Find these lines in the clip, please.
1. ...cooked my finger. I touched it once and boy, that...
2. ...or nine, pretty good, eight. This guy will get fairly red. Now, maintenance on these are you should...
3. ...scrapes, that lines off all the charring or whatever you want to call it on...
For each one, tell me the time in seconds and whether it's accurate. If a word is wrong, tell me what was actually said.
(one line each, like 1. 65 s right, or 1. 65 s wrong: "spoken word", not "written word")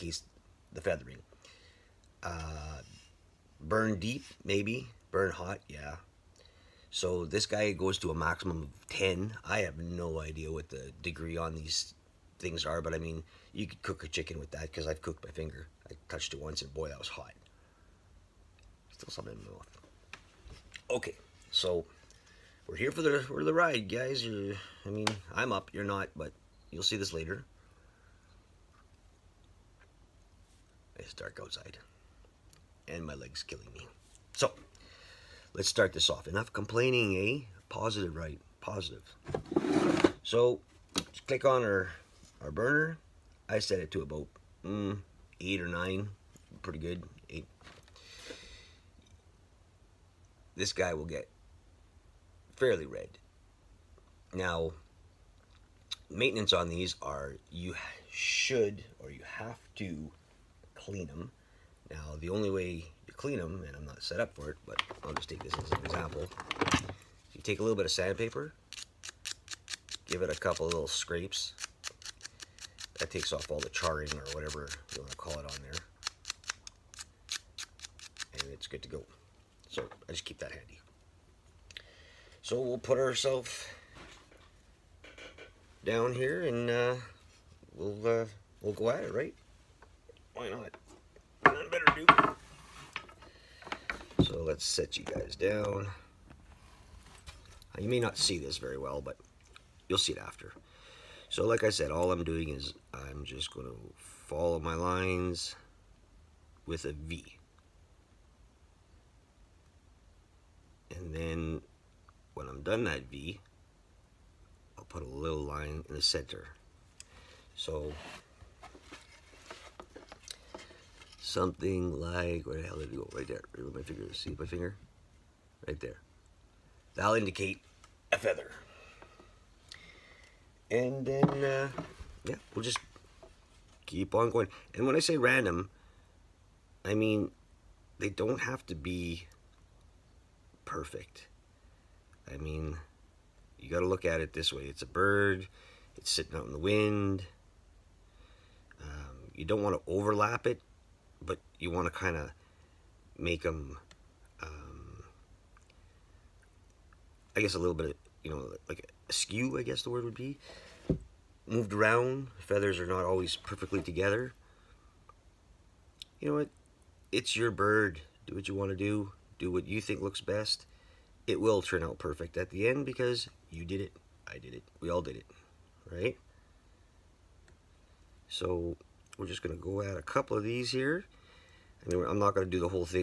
1. 15 s right
2. 45 s right
3. 70 s wrong: "takes", not "lines".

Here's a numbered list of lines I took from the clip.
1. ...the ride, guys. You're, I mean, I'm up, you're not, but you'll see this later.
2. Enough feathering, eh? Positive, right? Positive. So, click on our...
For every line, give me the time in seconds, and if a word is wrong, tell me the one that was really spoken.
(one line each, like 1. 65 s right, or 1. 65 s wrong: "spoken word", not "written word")
1. 23 s right
2. 36 s wrong: "complaining", not "feathering".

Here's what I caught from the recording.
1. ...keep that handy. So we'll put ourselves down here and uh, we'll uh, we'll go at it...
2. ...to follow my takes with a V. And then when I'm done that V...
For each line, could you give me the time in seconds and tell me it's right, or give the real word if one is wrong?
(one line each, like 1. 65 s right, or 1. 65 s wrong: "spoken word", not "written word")
1. 80 s right
2. 103 s wrong: "lines", not "takes".